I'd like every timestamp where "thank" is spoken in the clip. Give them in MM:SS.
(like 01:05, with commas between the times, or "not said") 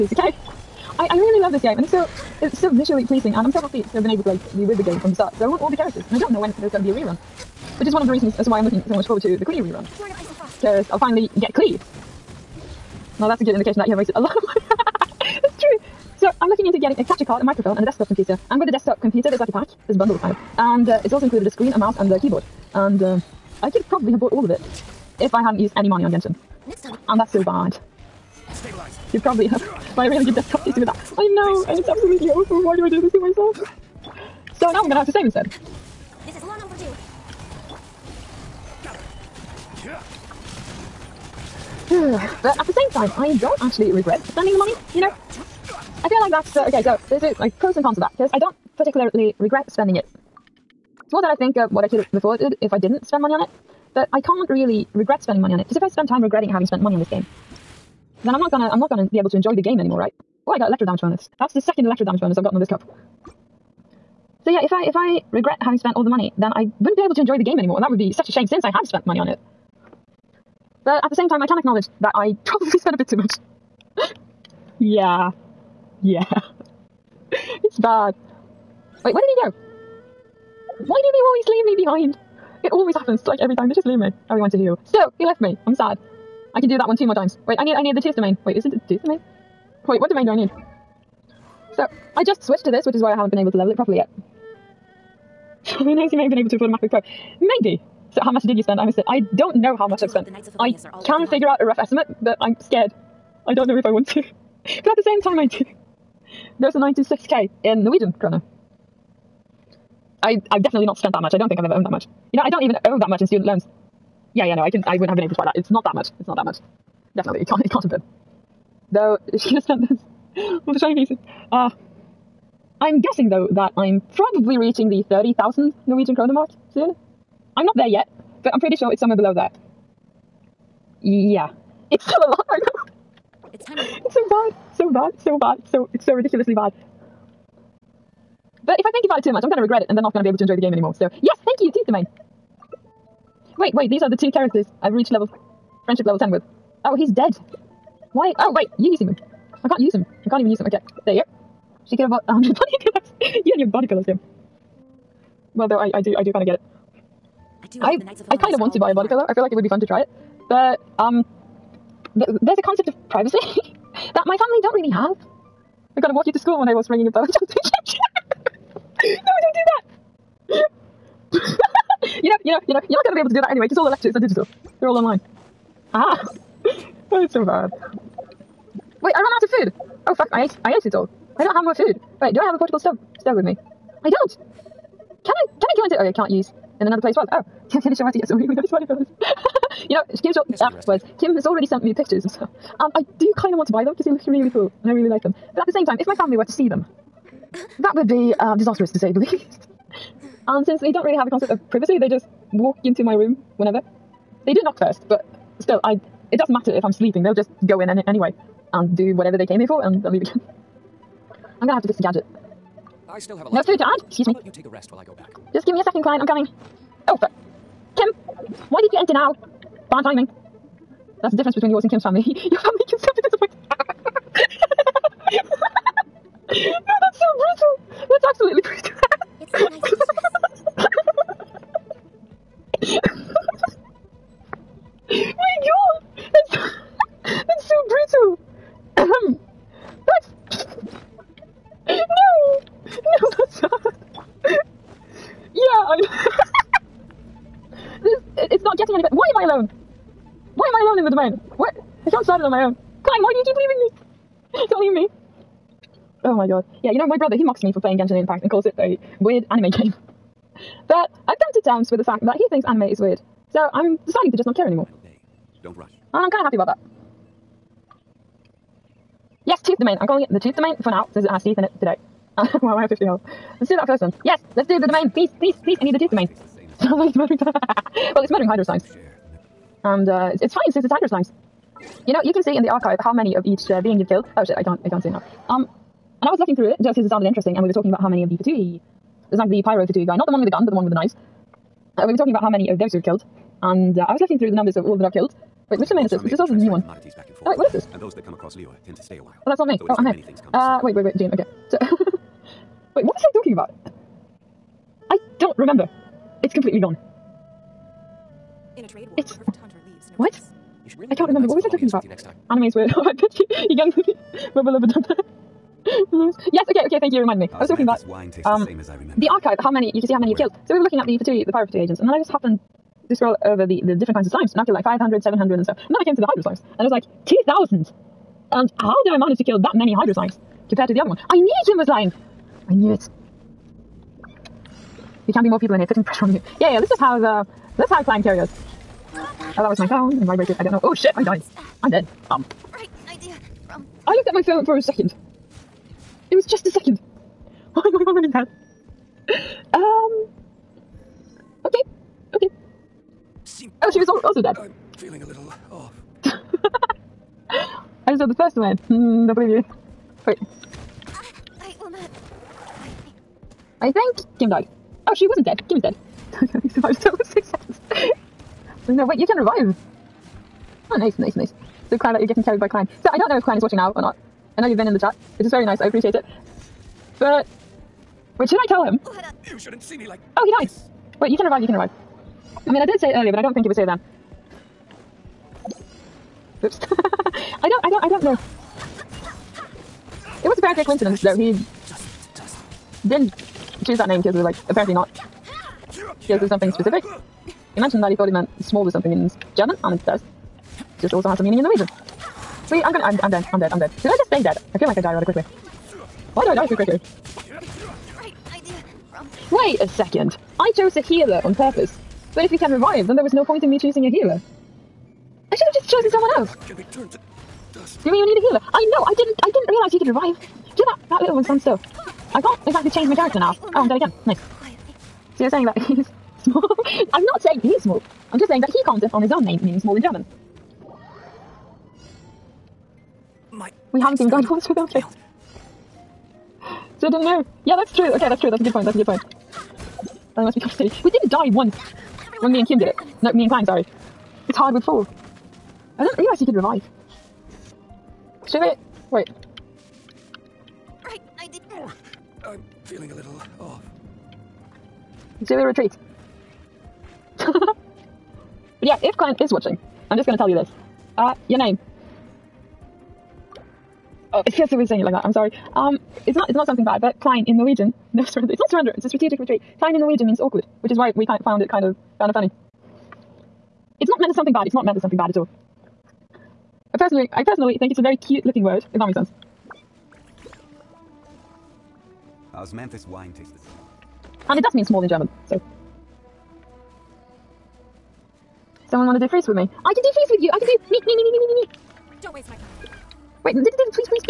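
02:21, 05:16.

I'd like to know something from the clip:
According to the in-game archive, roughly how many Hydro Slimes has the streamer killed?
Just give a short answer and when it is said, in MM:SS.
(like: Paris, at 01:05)
2,000, at 05:27.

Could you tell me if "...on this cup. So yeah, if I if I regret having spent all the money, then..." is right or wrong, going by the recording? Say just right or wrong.
right.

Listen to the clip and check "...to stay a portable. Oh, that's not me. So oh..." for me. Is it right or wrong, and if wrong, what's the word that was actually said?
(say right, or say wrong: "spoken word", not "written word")
wrong: "while", not "portable".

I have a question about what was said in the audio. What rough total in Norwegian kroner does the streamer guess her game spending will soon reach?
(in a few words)
30,000.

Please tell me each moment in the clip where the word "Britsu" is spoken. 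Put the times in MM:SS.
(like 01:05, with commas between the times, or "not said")
03:57.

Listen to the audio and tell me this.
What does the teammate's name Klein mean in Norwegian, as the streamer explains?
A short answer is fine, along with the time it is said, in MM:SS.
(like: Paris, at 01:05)
awkward, at 07:50.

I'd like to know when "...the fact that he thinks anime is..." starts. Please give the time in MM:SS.
04:21.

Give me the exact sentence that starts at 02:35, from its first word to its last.
Well, though, I, I do, I do kind of get it.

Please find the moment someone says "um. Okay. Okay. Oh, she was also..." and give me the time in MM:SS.
05:49.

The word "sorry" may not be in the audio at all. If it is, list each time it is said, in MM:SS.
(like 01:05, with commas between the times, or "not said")
07:23, 07:45.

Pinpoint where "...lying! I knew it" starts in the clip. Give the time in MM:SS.
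05:31.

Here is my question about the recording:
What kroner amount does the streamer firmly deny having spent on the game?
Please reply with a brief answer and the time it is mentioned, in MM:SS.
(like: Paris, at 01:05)
96k, at 01:46.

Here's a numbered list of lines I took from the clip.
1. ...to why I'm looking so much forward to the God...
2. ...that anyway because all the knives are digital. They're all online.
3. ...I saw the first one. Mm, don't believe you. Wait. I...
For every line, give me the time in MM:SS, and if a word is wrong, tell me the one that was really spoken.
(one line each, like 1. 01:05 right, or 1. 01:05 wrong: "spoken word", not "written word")
1. 00:08 wrong: "Klee", not "God"
2. 02:53 wrong: "lectures", not "knives"
3. 05:58 right.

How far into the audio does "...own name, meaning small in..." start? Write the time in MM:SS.
07:09.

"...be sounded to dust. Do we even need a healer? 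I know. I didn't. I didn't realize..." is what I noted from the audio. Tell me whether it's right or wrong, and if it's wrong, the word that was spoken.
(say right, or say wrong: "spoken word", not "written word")
wrong: "turned", not "sounded".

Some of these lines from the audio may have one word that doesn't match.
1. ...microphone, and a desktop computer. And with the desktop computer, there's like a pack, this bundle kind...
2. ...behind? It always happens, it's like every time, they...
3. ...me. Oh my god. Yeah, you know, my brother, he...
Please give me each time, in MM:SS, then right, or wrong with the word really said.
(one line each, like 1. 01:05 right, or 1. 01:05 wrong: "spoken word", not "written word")
1. 00:17 right
2. 01:21 right
3. 04:14 right.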